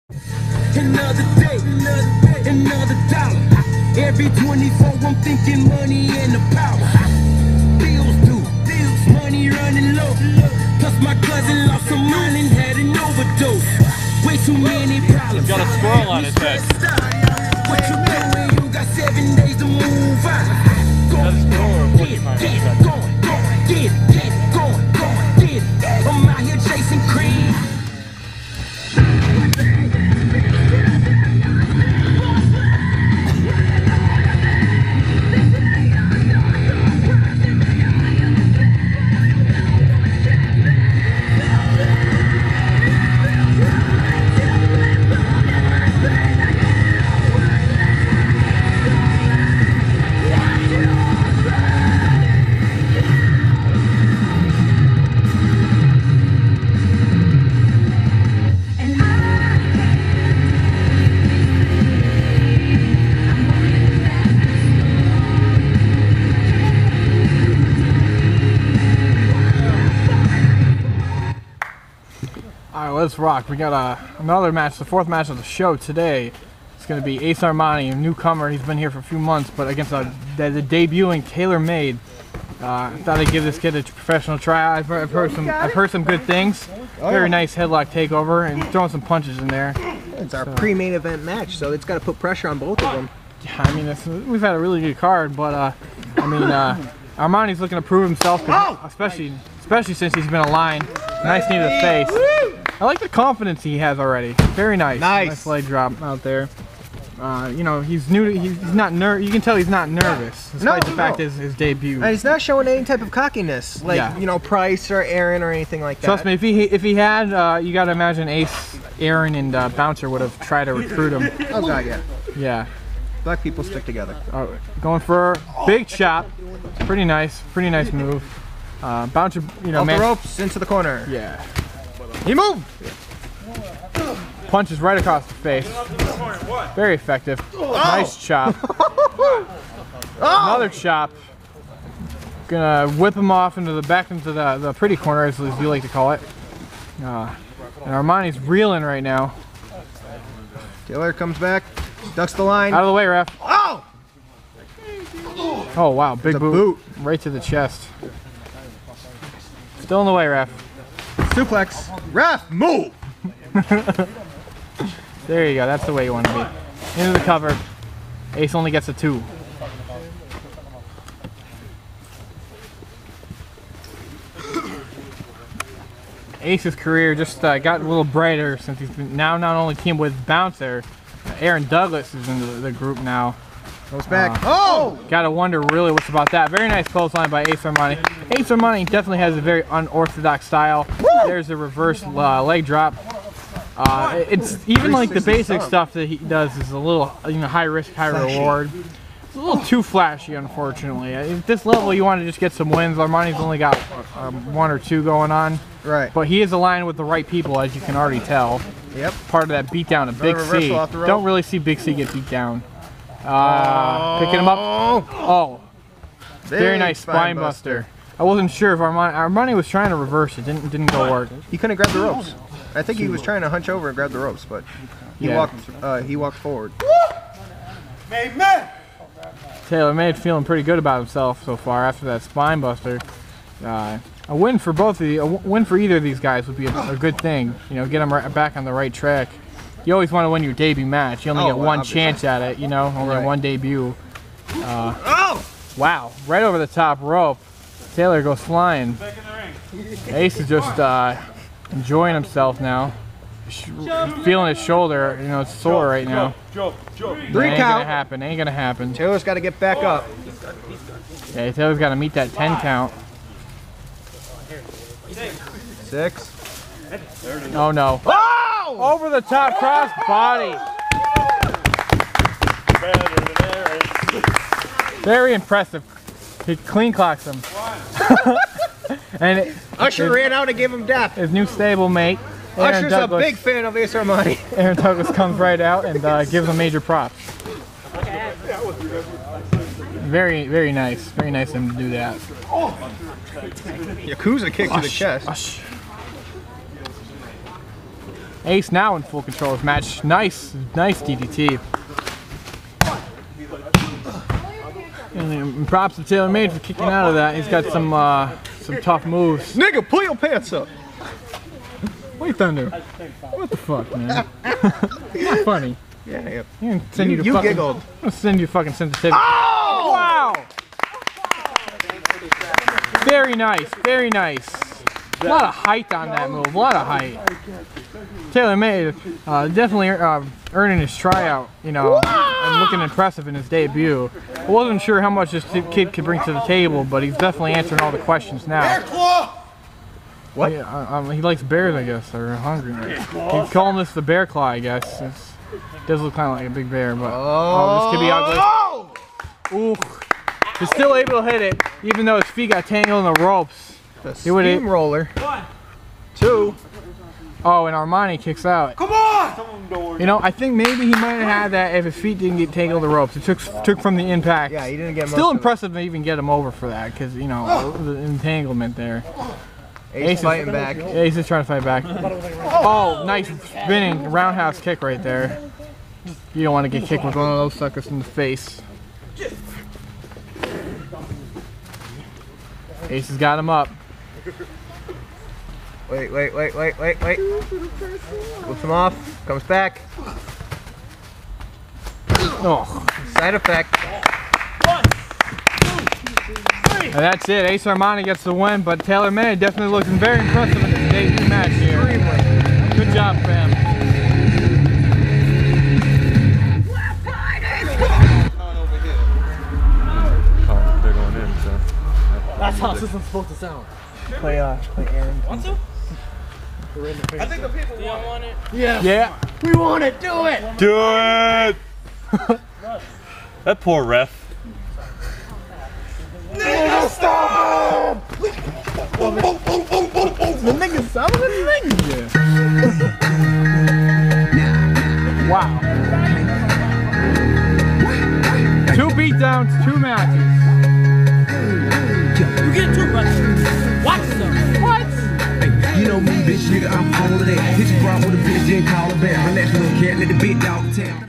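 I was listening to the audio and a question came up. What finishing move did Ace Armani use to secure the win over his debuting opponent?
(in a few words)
Side effect.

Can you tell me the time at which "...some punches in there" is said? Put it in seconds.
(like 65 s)
88 s.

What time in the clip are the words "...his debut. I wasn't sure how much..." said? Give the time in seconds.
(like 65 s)
333 s.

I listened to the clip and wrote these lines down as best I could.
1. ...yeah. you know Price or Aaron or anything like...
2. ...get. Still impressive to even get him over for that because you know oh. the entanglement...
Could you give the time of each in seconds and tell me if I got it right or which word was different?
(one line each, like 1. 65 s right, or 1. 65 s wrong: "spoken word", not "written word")
1. 113 s right
2. 364 s right.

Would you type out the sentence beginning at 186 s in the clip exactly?
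Very nice clothesline by Ace Armani.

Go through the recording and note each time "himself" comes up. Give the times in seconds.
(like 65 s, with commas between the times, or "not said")
98 s, 230 s, 252 s.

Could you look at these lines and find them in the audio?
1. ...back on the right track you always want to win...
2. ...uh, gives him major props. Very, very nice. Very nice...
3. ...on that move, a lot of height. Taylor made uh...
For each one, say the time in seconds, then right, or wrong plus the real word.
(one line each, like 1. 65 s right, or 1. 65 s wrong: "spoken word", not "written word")
1. 238 s right
2. 286 s right
3. 325 s right.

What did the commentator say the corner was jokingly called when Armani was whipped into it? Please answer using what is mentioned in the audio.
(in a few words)
The pretty corner.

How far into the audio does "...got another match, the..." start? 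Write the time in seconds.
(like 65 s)
73 s.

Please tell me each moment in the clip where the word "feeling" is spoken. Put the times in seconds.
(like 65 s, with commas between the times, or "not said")
230 s, 254 s.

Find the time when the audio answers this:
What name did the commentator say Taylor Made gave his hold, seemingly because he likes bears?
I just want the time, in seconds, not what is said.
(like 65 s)
343 s.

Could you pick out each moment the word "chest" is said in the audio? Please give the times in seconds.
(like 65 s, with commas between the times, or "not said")
157 s, 294 s.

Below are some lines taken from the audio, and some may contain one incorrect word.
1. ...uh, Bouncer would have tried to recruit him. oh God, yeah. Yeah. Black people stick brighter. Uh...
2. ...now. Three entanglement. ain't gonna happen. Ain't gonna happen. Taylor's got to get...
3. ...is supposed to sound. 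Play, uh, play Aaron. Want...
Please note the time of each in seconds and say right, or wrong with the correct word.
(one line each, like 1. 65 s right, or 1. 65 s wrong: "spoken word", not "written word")
1. 119 s wrong: "together", not "brighter"
2. 256 s wrong: "count", not "entanglement"
3. 412 s right.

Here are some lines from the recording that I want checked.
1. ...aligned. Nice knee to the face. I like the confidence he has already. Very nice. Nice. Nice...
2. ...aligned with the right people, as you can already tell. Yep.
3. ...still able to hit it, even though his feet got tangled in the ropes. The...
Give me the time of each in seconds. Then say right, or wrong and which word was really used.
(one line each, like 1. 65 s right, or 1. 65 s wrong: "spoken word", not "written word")
1. 100 s right
2. 206 s right
3. 350 s right.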